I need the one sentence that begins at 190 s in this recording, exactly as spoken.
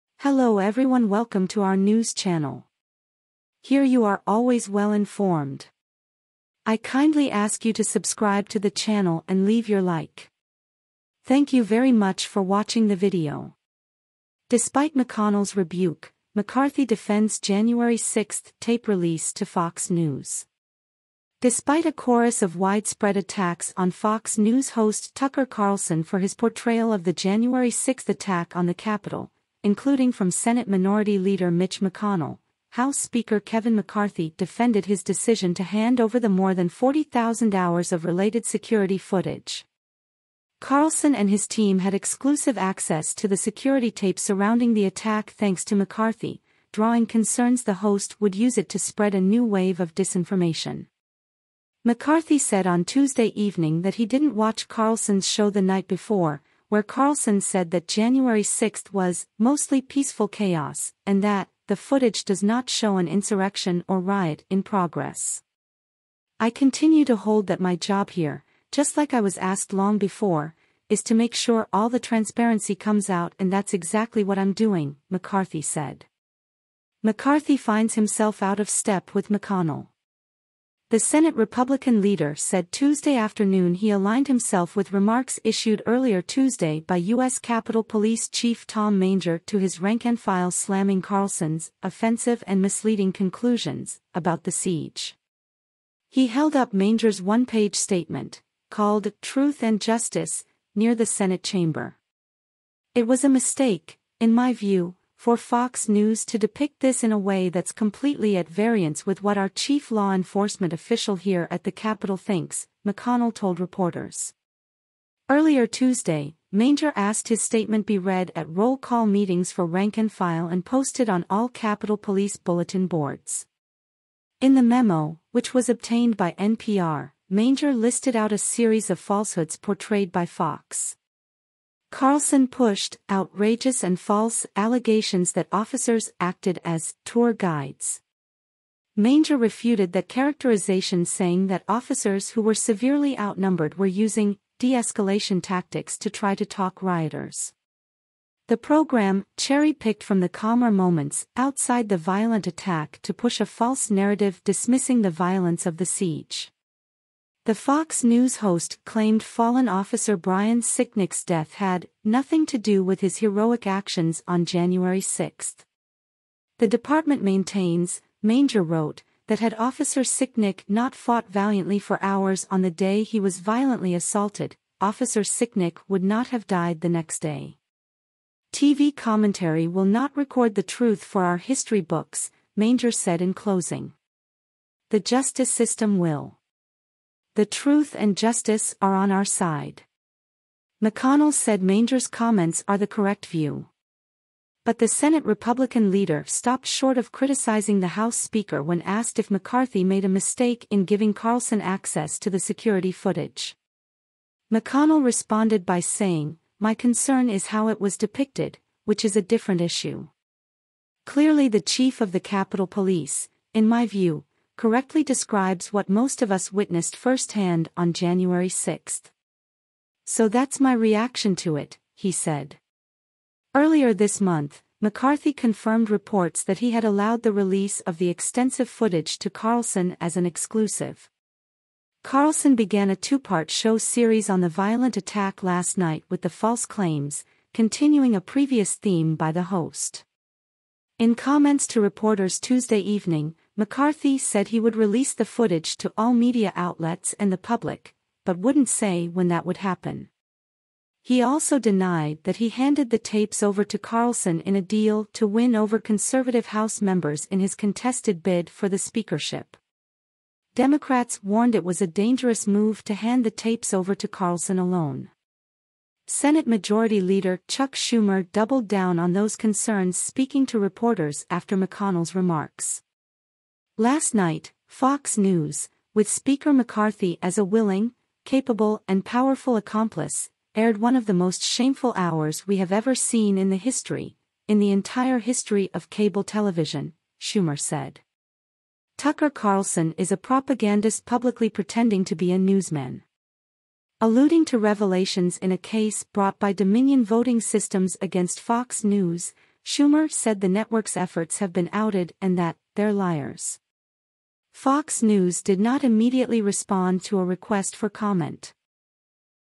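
McConnell said Manger's comments are the correct view.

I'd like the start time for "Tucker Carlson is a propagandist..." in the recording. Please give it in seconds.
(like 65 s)
288 s.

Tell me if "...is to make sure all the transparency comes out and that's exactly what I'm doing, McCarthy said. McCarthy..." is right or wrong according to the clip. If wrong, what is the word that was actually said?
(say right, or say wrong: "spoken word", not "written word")
right.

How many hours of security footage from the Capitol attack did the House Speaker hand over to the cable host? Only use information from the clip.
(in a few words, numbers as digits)
40,000.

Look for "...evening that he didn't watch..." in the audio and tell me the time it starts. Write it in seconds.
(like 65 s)
53 s.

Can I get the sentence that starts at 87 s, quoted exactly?
Capitol Police Chief Tom Manger to his rank-and-file slamming Carlson's offensive and misleading conclusions about the siege.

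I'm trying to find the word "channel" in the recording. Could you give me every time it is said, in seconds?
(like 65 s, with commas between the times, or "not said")
2 s, 8 s.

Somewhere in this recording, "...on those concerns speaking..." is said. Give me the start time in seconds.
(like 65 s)
268 s.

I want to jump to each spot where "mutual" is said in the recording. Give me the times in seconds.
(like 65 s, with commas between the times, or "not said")
not said.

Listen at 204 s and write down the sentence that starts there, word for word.
McConnell responded by saying, My concern is how it was depicted, which is a different issue.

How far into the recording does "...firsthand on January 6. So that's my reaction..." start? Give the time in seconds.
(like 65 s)
216 s.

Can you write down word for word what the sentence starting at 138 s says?
Manger refuted that characterization saying that officers who were severely outnumbered were using de-escalation tactics to try to talk rioters.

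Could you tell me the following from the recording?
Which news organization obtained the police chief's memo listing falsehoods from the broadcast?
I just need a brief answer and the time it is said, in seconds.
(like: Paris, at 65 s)
NPR, at 126 s.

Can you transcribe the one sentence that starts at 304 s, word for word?
Fox News did not immediately respond to a request for comment.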